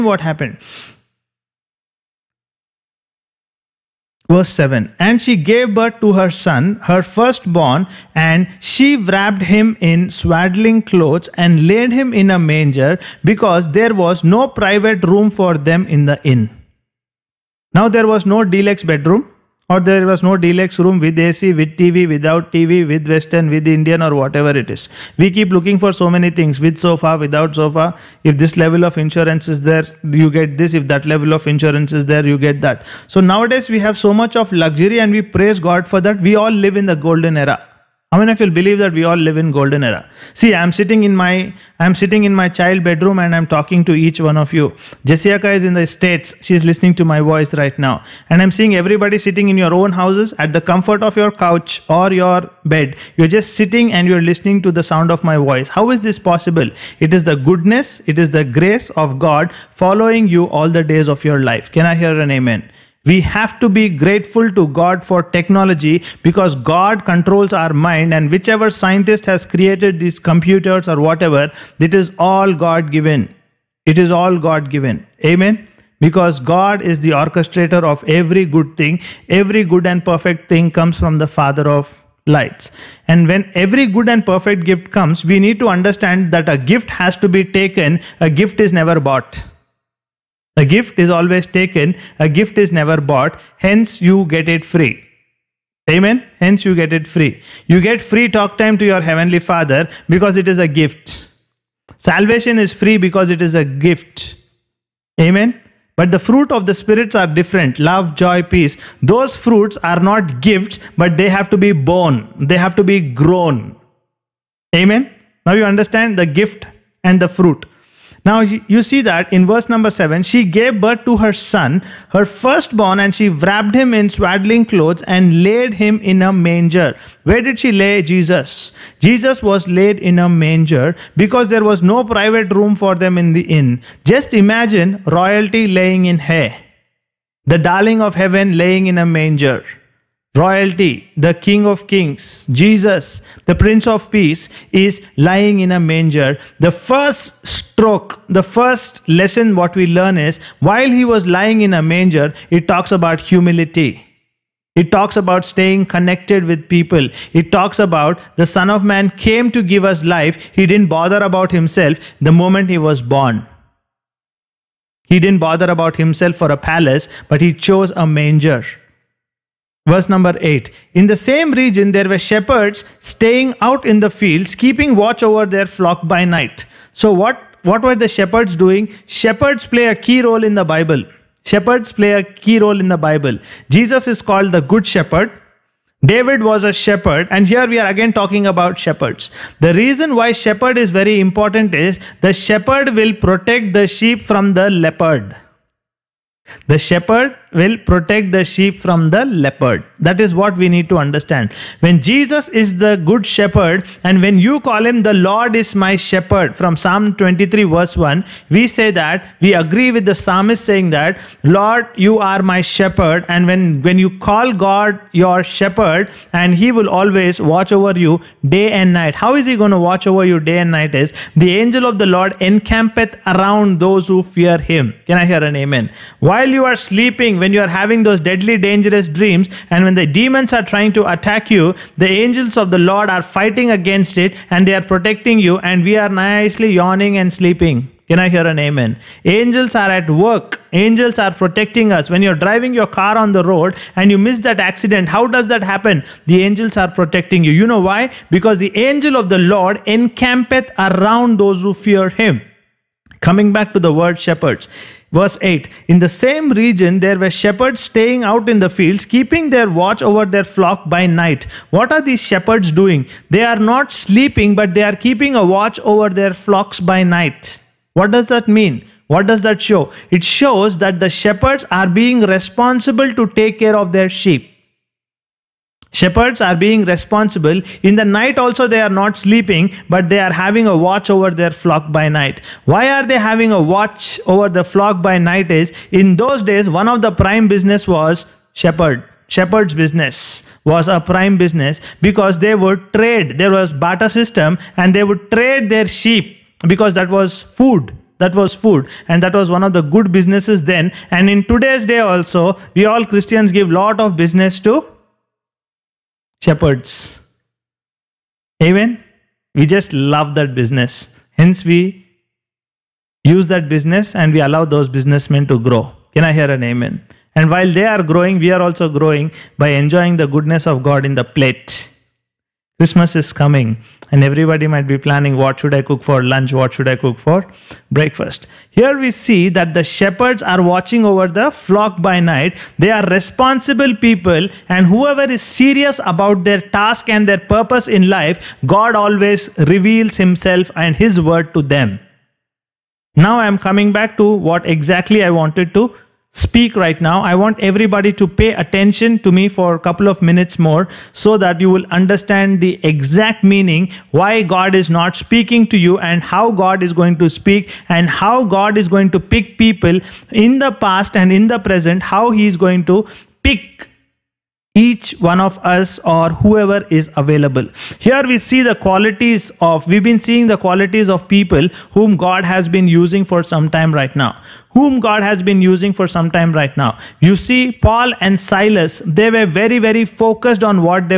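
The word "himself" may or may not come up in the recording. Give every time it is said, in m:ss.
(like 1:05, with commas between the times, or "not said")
2:41, 2:45, 5:40.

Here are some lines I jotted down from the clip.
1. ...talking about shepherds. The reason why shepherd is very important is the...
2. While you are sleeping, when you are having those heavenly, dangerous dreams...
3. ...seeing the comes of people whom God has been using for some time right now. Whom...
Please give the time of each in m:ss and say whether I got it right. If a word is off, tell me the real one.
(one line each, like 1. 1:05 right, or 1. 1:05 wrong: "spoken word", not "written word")
1. 3:08 right
2. 3:46 wrong: "deadly", not "heavenly"
3. 6:10 wrong: "qualities", not "comes".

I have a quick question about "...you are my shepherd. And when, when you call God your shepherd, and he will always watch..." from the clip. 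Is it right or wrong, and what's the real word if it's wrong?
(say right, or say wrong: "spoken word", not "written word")
right.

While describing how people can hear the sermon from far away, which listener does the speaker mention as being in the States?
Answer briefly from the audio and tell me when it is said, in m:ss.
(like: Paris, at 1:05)
Jessica, at 0:45.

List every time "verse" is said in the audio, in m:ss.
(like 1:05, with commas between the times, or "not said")
0:04, 1:59, 2:49, 3:27, 4:15.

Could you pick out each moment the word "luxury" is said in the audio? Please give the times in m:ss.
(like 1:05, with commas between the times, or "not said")
0:34.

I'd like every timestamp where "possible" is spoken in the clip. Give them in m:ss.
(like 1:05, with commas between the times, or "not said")
0:56.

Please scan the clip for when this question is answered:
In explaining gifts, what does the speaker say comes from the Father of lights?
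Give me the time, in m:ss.
1:19.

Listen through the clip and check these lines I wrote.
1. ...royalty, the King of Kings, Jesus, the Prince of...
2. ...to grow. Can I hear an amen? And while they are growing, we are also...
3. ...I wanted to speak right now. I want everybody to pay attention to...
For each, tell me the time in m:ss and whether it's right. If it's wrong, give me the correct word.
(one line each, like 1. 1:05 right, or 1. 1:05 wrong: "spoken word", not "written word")
1. 2:20 right
2. 5:15 right
3. 5:45 right.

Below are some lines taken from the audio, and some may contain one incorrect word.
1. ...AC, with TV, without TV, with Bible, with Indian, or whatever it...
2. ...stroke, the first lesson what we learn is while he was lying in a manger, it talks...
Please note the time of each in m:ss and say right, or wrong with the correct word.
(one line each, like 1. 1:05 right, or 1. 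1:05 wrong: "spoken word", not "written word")
1. 0:21 wrong: "Western", not "Bible"
2. 2:27 right.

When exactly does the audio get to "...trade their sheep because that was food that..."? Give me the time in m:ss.
4:55.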